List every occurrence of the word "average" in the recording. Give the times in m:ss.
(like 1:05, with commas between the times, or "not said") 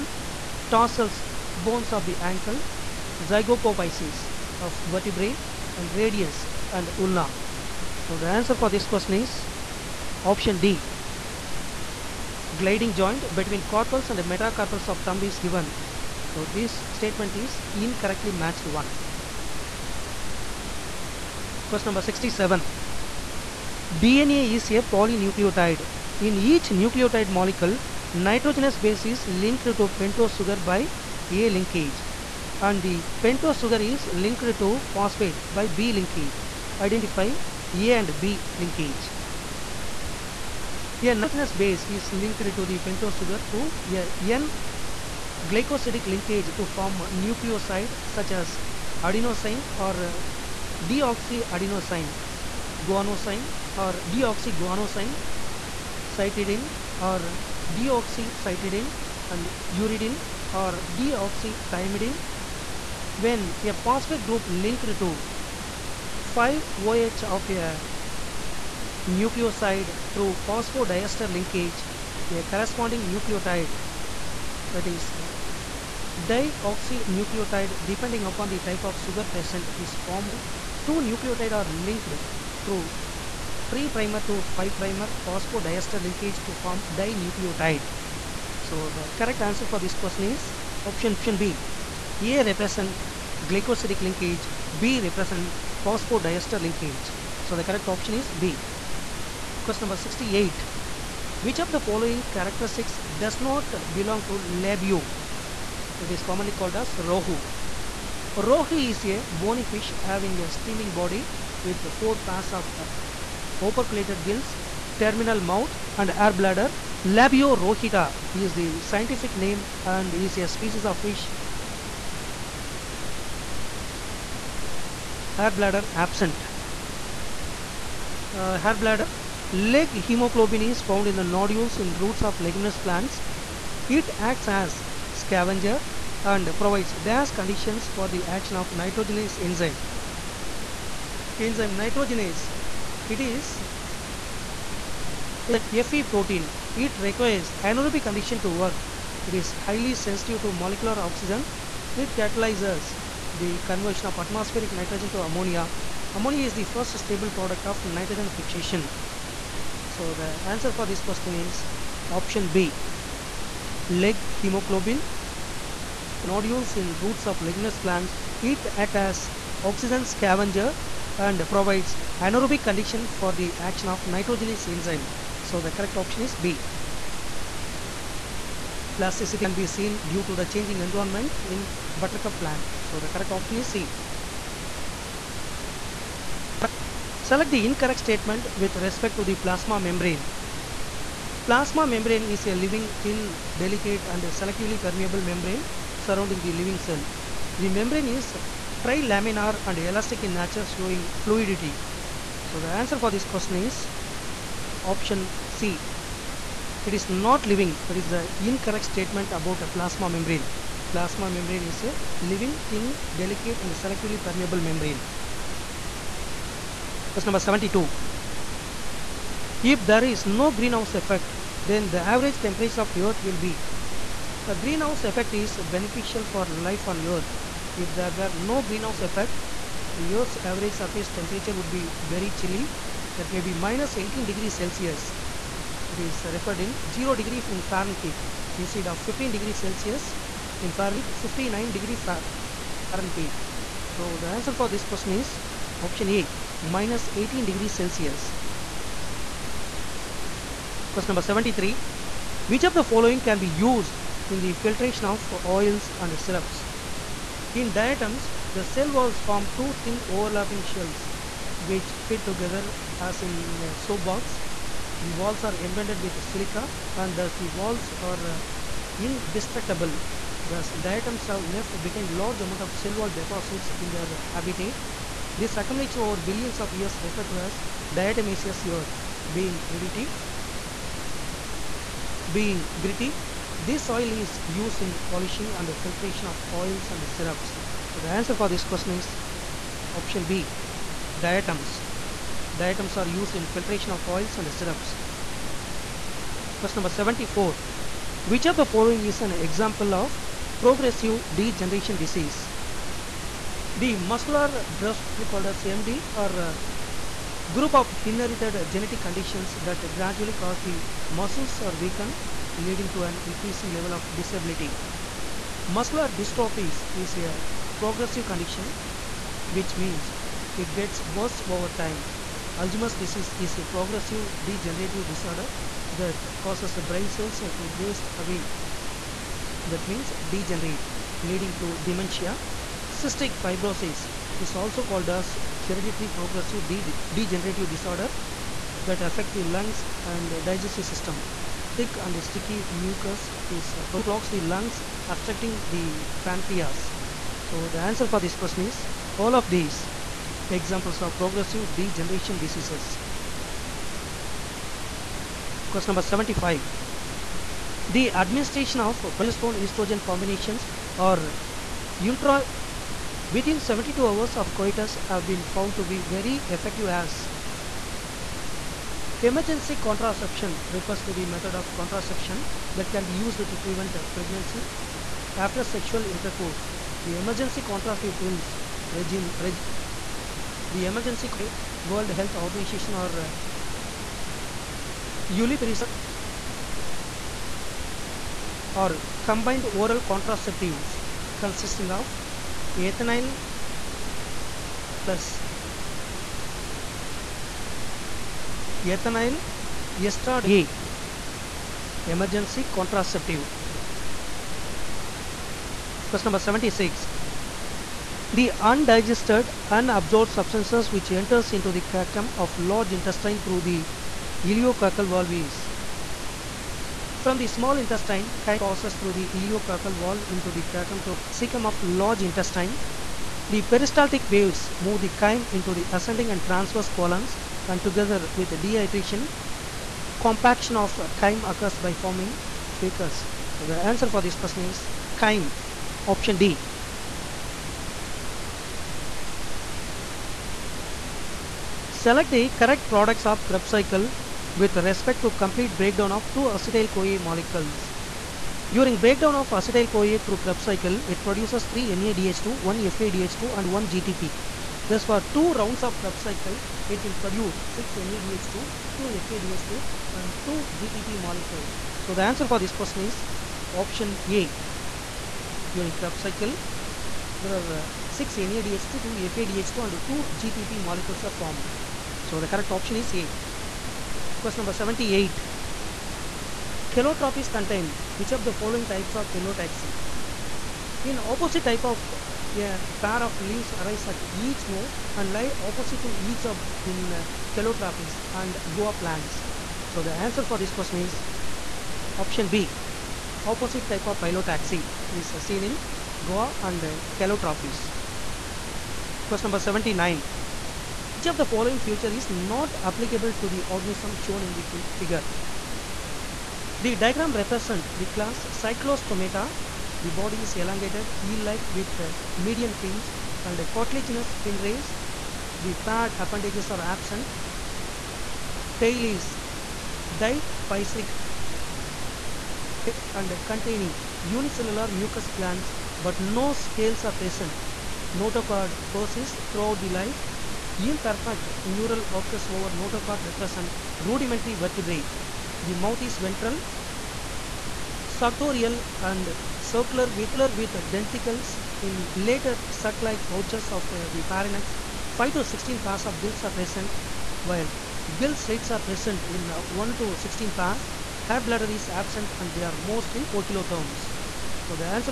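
3:42, 3:50.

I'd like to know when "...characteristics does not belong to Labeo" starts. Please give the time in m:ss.
1:42.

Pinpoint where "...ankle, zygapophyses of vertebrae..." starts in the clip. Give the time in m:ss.
0:02.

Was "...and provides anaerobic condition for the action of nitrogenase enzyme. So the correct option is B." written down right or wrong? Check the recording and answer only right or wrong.
right.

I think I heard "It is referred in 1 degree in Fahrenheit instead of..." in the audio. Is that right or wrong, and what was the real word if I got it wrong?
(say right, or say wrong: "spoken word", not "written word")
wrong: "0", not "1".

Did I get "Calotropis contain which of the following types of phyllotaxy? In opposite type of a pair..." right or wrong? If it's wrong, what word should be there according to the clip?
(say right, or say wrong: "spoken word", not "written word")
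right.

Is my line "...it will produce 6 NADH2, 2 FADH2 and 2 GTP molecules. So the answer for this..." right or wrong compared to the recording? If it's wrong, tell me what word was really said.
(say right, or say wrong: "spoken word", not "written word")
right.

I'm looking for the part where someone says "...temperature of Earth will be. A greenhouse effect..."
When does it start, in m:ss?
3:42.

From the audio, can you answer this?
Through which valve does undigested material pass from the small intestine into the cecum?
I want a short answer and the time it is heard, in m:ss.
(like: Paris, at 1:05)
Ileocecal valve, at 6:54.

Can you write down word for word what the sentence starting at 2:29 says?
It is highly sensitive to molecular oxygen.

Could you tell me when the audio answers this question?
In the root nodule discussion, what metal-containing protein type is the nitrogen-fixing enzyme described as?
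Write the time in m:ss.
2:25.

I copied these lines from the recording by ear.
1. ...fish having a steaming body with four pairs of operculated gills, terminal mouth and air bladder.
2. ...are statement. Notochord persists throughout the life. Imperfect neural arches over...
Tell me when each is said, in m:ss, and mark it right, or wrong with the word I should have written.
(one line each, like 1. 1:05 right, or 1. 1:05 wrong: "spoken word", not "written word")
1. 1:49 right
2. 8:47 wrong: "present", not "statement".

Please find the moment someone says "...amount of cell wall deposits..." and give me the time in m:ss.
4:32.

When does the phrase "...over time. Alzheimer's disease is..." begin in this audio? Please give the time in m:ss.
5:21.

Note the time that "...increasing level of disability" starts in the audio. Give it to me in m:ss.
5:13.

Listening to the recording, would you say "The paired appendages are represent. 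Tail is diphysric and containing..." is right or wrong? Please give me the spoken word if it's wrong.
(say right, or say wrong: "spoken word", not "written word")
wrong: "absent", not "represent".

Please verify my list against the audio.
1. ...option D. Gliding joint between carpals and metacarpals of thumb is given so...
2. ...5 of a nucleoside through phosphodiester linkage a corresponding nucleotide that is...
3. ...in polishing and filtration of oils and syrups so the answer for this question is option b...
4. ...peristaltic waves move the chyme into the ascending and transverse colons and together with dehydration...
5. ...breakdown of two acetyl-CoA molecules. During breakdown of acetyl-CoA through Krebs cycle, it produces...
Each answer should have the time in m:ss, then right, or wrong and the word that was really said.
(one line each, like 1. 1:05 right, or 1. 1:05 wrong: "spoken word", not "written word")
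1. 0:10 right
2. 1:06 right
3. 4:44 right
4. 7:03 right
5. 7:25 right.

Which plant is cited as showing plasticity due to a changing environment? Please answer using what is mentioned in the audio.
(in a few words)
Buttercup.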